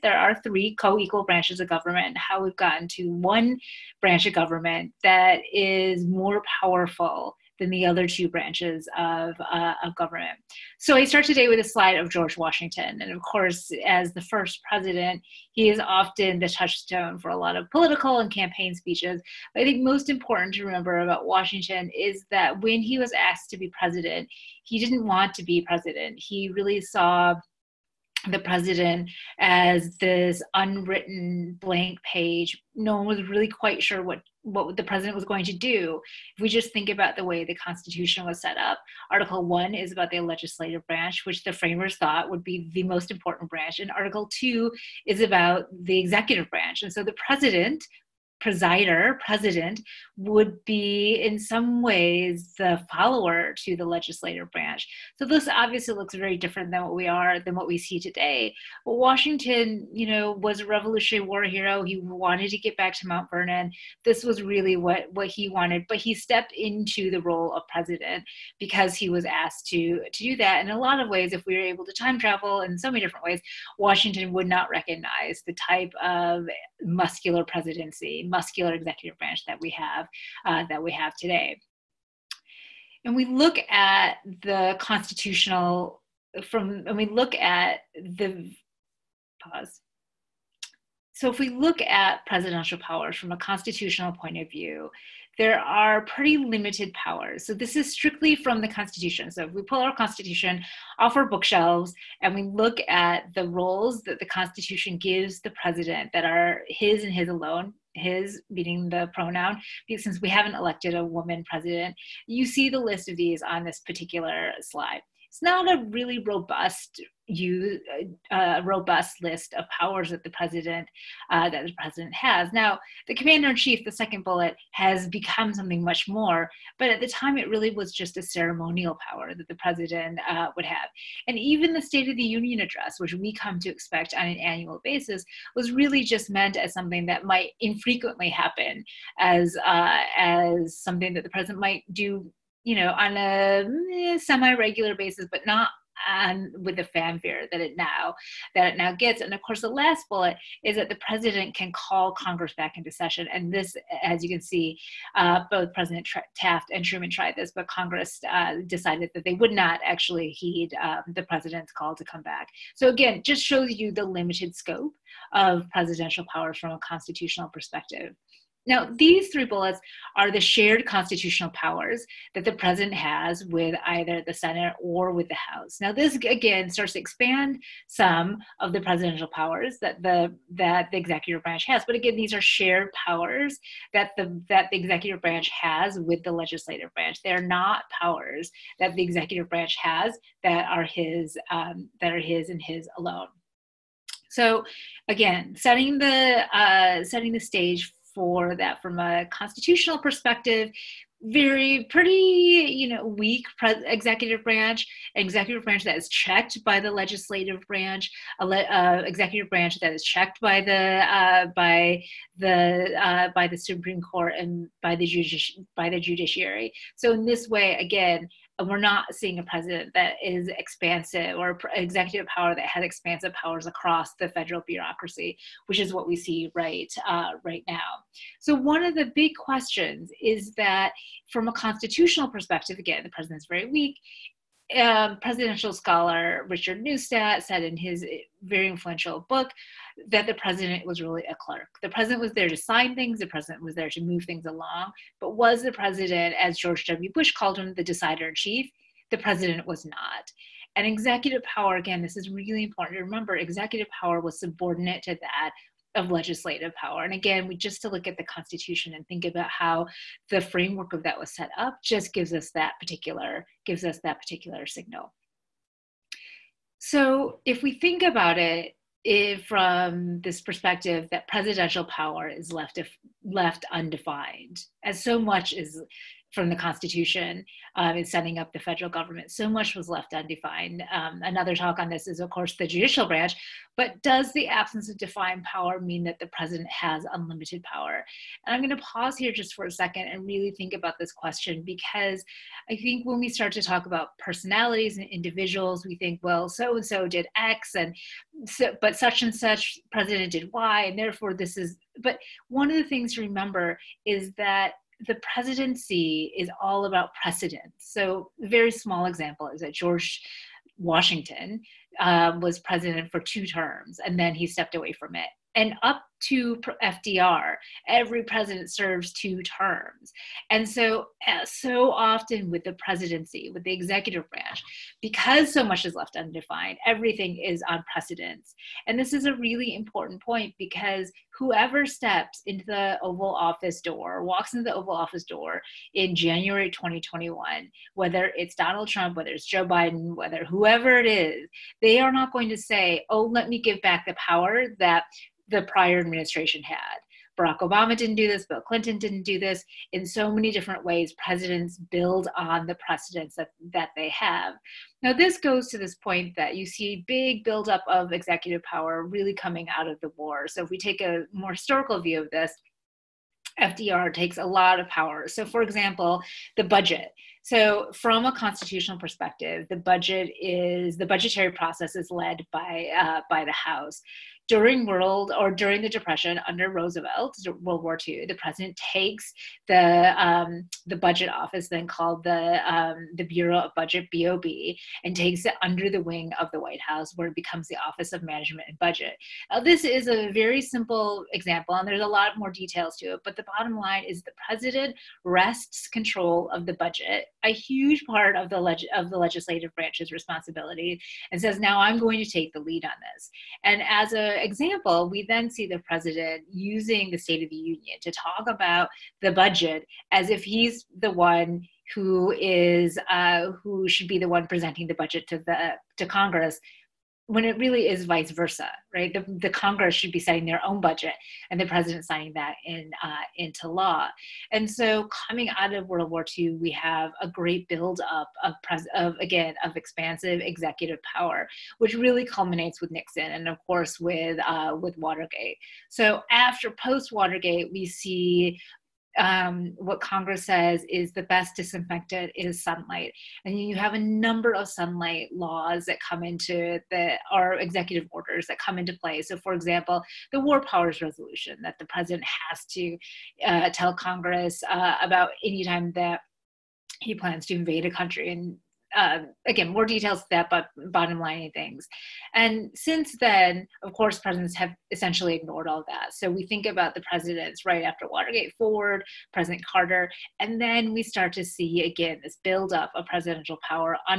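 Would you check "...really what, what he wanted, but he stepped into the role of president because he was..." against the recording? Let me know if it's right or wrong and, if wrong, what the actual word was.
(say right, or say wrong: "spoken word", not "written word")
right.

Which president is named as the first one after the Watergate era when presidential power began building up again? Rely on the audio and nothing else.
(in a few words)
Carter.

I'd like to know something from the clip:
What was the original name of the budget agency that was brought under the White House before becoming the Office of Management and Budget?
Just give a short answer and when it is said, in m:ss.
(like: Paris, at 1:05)
Bureau of Budget, at 6:23.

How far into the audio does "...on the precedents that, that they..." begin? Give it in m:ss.
5:52.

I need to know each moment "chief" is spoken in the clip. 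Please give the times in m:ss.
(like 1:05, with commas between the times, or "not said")
2:03, 4:08.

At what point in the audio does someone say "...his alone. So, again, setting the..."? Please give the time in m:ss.
3:12.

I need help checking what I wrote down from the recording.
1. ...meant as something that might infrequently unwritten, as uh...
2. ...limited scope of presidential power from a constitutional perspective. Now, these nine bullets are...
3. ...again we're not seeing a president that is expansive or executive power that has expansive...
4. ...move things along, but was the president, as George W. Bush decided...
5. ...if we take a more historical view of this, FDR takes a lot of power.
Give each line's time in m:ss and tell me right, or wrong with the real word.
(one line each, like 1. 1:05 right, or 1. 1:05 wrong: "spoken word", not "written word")
1. 2:16 wrong: "happen", not "unwritten"
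2. 2:44 wrong: "three", not "nine"
3. 3:37 right
4. 4:03 wrong: "called", not "decided"
5. 6:00 right.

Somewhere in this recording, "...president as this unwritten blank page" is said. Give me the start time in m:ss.
0:28.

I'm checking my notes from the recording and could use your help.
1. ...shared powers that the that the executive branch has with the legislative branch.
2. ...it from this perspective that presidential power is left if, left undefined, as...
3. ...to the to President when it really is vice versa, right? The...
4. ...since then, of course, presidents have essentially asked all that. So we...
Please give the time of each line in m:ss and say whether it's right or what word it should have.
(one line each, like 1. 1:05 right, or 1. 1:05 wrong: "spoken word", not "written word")
1. 3:02 right
2. 4:29 right
3. 6:55 wrong: "Congress", not "President"
4. 7:42 wrong: "ignored", not "asked".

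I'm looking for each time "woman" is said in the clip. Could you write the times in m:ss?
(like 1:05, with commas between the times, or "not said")
1:51.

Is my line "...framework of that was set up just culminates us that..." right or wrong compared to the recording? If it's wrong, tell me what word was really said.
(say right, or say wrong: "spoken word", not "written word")
wrong: "gives", not "culminates".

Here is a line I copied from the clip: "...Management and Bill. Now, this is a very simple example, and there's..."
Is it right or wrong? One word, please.
wrong.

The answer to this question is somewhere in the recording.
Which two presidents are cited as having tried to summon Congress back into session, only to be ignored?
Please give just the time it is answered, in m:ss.
2:36.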